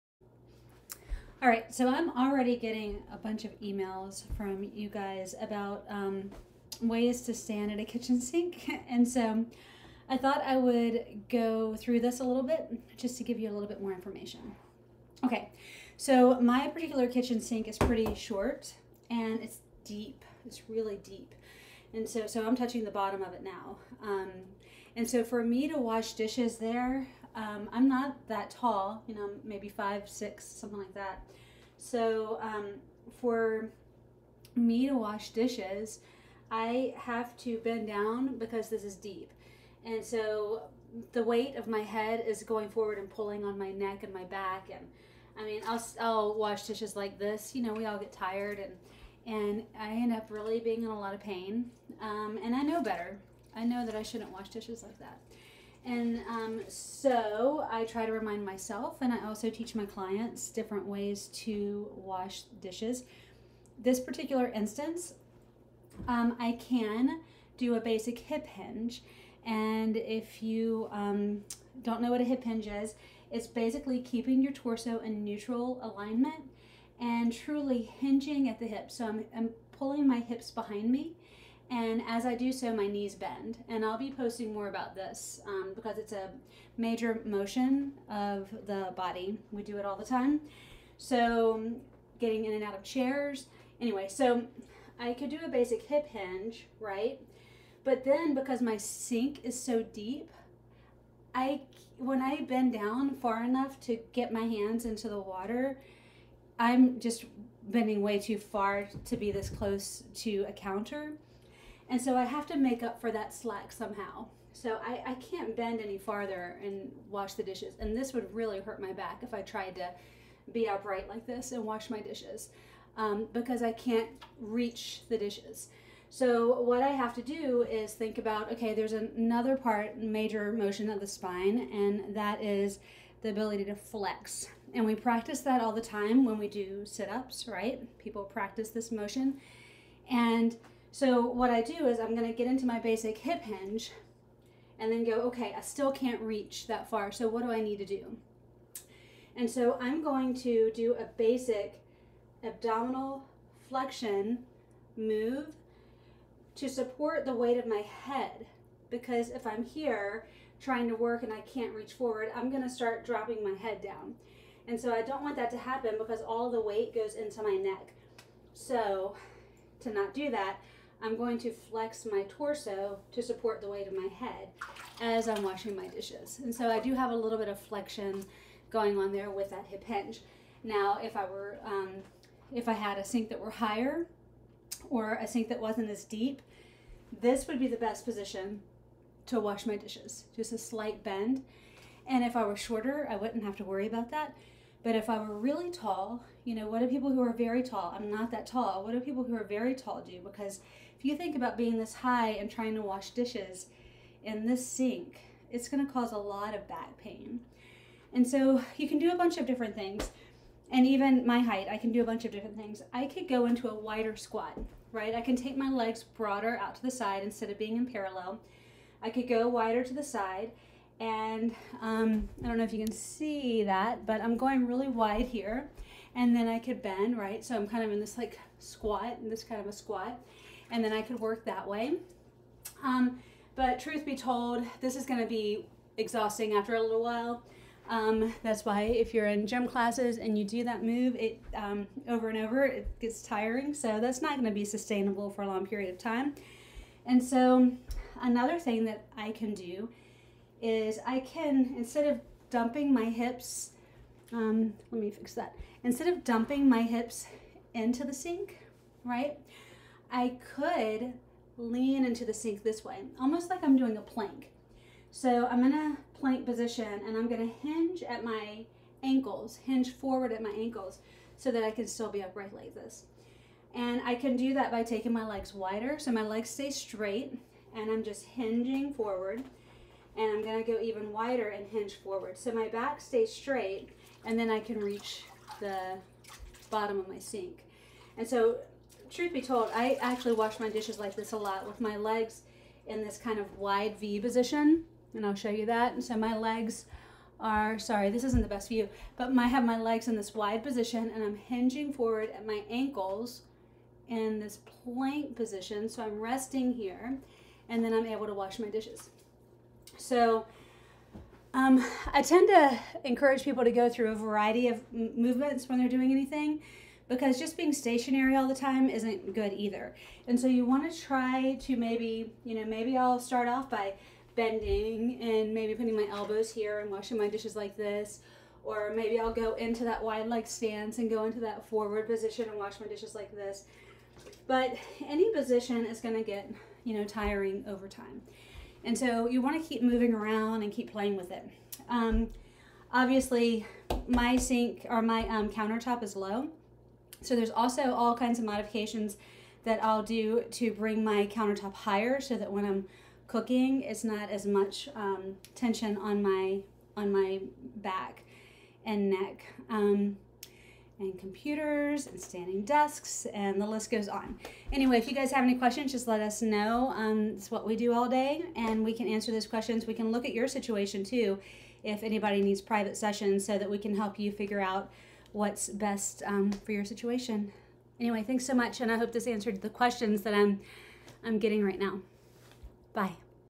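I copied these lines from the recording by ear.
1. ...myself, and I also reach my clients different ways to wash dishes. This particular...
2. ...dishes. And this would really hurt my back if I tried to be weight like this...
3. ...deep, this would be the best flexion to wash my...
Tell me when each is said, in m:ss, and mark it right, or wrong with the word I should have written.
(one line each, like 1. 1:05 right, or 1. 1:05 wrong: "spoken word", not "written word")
1. 0:58 wrong: "teach", not "reach"
2. 1:57 wrong: "upright", not "weight"
3. 3:06 wrong: "position", not "flexion".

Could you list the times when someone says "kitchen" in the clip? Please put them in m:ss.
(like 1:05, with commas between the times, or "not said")
0:07, 0:17.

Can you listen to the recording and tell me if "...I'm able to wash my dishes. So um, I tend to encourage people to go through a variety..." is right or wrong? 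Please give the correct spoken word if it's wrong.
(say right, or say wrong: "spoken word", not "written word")
right.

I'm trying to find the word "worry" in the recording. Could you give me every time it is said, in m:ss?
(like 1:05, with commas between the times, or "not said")
3:13.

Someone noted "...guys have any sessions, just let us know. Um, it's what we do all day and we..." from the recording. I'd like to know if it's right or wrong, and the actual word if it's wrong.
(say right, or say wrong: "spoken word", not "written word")
wrong: "questions", not "sessions".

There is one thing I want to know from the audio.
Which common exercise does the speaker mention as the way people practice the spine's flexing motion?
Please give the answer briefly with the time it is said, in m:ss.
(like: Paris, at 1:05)
sit-ups, at 2:16.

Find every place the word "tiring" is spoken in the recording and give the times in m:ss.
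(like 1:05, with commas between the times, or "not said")
4:03, 5:37.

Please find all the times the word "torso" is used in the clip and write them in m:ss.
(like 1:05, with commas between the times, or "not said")
1:14, 2:52.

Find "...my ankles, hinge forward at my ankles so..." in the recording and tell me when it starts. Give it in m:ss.
4:28.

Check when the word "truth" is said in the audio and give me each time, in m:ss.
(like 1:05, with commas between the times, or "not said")
3:53, 4:49.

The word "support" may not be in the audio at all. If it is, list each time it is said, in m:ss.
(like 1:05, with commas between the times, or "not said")
2:36, 2:53.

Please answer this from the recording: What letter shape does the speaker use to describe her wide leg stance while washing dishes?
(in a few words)
V.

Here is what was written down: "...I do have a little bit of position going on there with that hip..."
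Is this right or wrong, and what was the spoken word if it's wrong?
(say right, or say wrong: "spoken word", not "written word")
wrong: "flexion", not "position".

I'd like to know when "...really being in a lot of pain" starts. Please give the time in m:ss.
0:50.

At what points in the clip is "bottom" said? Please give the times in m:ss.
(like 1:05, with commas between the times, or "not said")
0:22, 4:46.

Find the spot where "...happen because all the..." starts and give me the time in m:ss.
2:45.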